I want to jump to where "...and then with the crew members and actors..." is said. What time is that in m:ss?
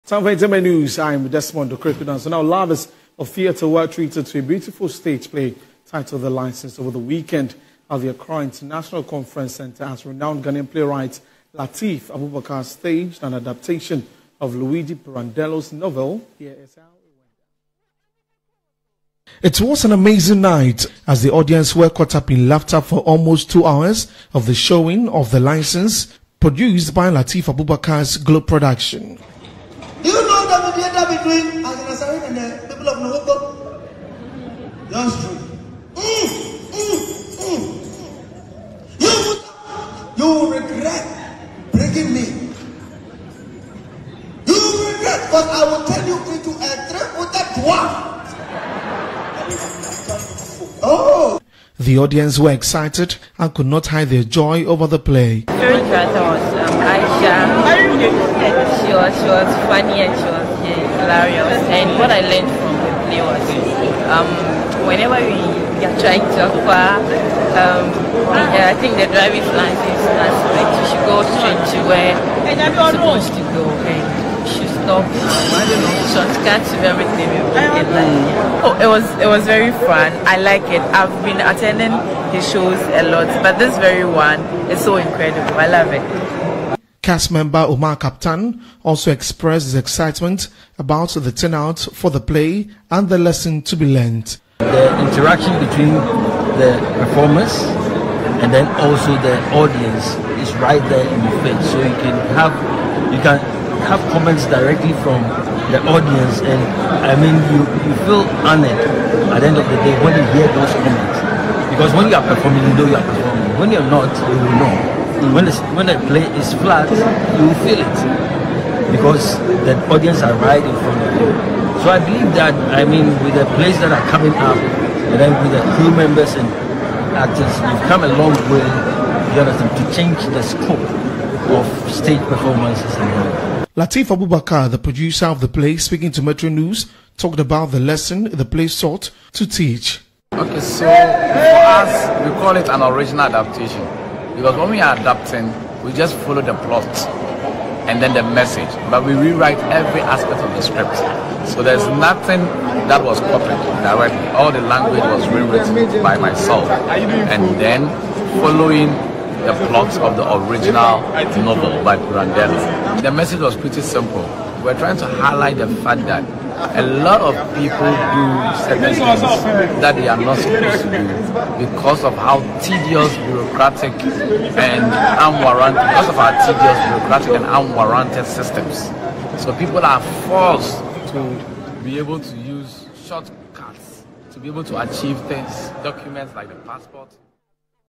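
2:04.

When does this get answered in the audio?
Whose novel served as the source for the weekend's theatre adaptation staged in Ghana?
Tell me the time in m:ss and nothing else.
0:14.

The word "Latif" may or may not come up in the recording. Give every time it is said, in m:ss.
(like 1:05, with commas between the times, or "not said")
0:11, 0:27, 2:13.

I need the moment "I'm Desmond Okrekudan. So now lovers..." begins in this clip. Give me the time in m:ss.
0:00.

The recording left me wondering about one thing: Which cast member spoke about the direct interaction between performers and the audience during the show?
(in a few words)
Omar Kaptan.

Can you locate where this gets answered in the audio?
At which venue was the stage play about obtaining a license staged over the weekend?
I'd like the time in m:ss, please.
0:08.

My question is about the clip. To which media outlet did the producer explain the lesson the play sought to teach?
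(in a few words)
Metro News.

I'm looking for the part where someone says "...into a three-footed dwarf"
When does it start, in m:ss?
0:46.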